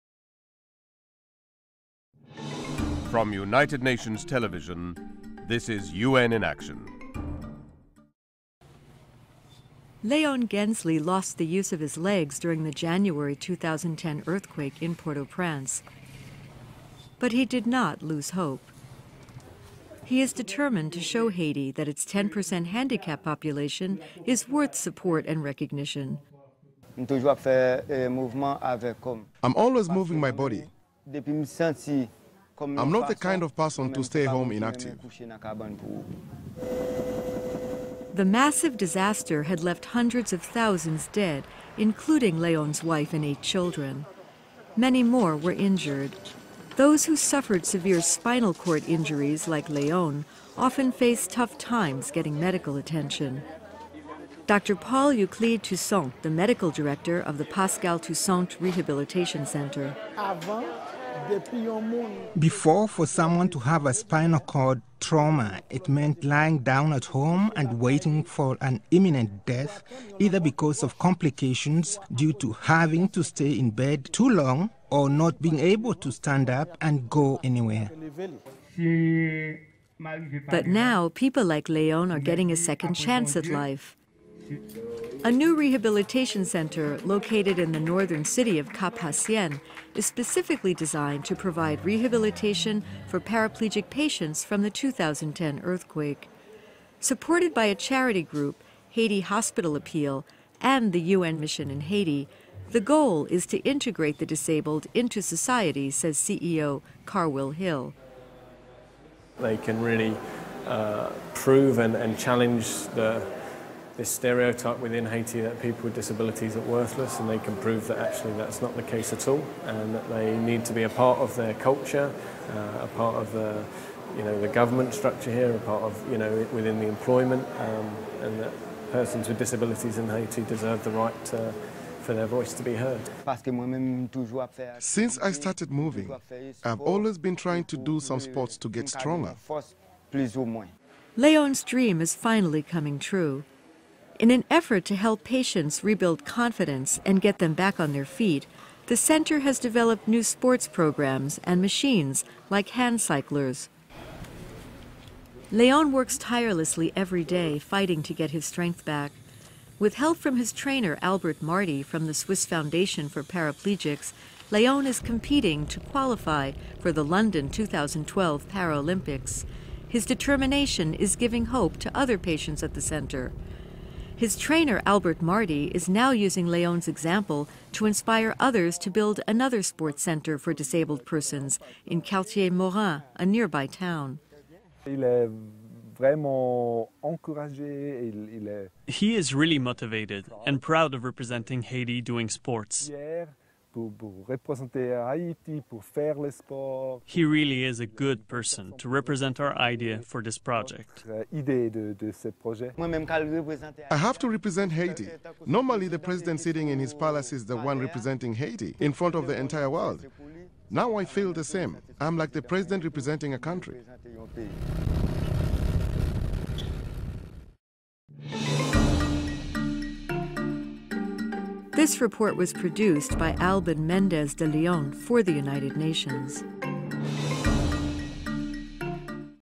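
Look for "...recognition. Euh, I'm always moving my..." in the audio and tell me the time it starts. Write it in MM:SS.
00:25.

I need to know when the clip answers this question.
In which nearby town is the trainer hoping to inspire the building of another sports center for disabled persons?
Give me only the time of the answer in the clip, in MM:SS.
03:02.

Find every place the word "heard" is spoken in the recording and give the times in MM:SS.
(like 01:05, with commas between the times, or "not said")
02:12.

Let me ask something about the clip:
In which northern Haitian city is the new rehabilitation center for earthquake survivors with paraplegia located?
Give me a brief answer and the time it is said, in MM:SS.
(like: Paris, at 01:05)
Cap Haitien, at 01:28.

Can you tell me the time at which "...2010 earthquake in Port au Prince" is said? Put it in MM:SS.
00:13.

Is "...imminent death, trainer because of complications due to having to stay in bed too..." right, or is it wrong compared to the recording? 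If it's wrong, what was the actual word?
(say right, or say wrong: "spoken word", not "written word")
wrong: "either", not "trainer".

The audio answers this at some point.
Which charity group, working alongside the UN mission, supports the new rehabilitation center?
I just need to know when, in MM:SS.
01:38.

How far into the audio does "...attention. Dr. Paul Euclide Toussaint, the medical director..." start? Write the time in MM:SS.
00:52.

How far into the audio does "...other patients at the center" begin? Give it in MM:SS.
02:51.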